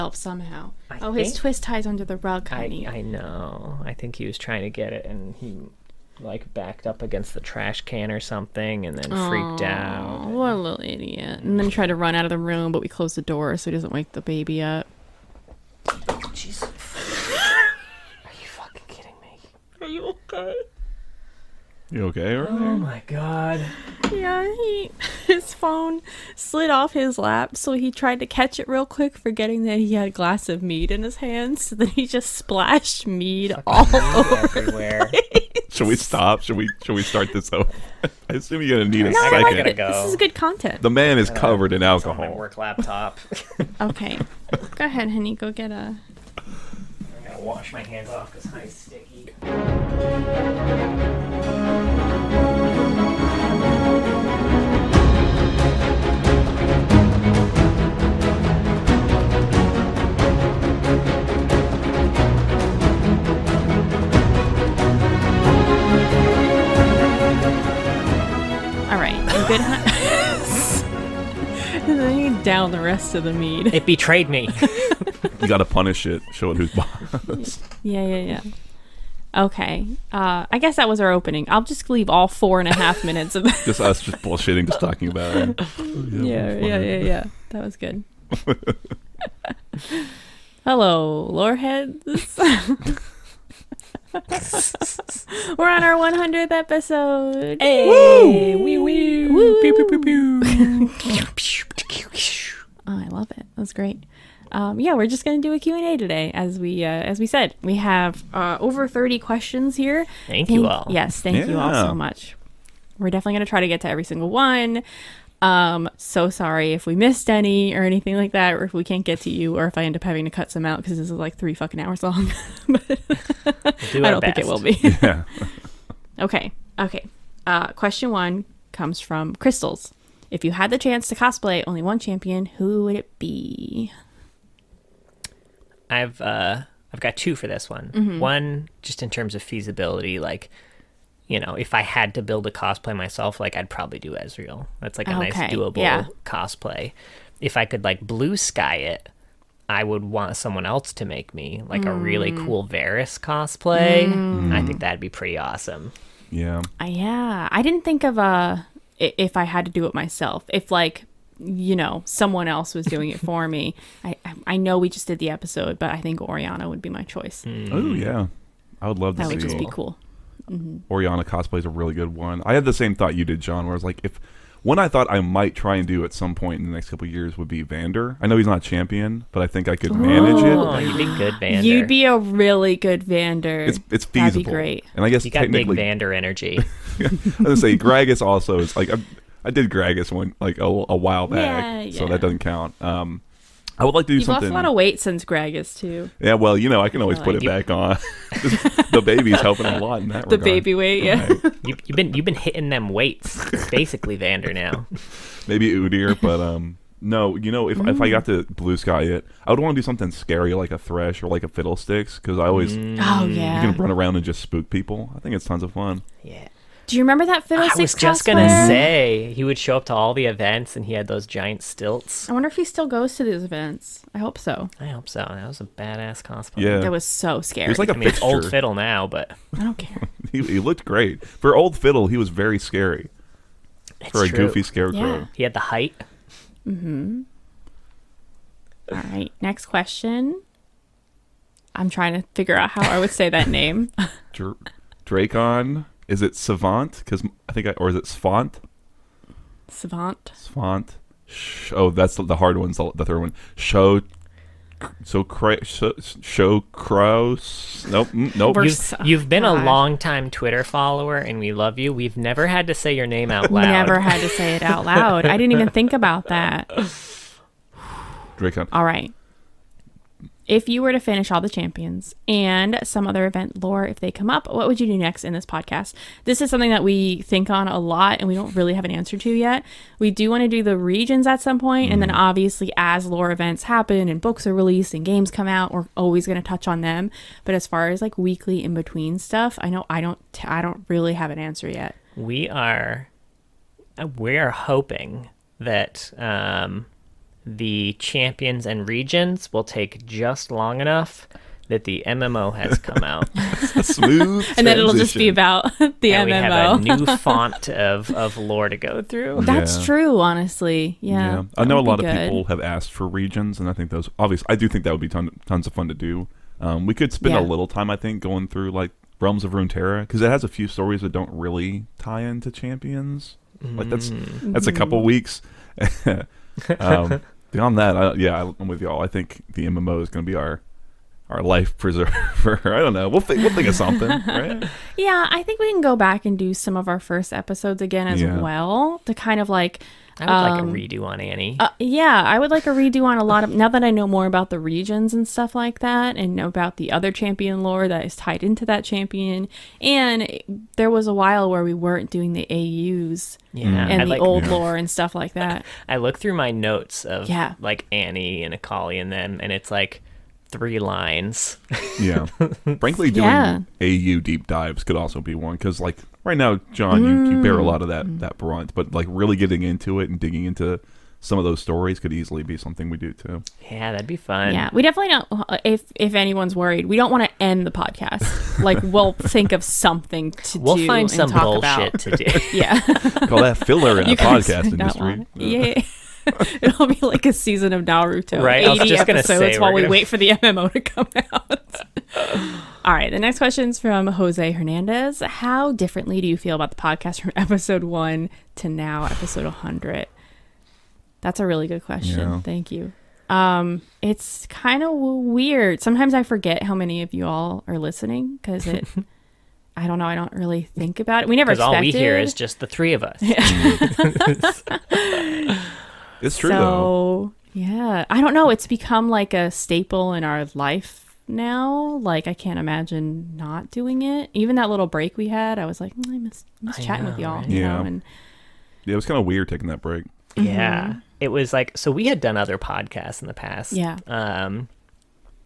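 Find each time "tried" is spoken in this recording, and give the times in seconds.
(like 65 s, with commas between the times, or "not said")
11 s, 27 s.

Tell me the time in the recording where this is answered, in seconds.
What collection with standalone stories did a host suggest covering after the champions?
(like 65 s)
319 s.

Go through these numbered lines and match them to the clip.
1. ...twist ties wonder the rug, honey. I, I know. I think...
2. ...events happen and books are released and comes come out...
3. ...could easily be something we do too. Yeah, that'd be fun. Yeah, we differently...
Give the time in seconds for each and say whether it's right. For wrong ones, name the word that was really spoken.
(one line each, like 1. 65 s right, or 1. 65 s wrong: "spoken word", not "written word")
1. 1 s wrong: "under", not "wonder"
2. 283 s wrong: "games", not "comes"
3. 371 s wrong: "definitely", not "differently".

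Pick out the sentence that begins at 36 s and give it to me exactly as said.
Should we should we start this over?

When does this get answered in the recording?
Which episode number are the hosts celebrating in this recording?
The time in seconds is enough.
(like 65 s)
95 s.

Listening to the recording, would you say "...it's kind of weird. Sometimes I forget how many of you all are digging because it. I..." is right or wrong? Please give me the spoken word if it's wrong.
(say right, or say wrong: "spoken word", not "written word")
wrong: "listening", not "digging".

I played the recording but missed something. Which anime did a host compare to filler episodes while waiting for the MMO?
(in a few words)
Naruto.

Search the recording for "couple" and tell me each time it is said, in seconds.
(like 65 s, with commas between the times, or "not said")
176 s, 324 s.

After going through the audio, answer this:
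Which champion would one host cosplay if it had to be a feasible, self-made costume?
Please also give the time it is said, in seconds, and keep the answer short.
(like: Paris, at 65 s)
Ezreal, at 144 s.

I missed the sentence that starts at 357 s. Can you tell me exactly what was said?
like Annie and Akali and them, and it's like three lines.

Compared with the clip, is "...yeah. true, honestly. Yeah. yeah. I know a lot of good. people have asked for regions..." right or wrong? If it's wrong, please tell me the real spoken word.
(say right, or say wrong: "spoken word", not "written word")
right.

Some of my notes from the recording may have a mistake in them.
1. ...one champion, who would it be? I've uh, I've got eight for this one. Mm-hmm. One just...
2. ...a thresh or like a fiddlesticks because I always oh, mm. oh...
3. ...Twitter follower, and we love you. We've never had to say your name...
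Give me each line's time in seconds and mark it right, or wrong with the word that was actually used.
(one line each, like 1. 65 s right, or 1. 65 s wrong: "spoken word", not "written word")
1. 131 s wrong: "two", not "eight"
2. 210 s right
3. 260 s right.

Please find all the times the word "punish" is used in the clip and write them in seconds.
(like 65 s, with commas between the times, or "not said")
75 s.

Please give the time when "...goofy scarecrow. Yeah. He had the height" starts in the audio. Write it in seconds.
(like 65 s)
234 s.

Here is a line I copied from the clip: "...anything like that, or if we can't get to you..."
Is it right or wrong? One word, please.
right.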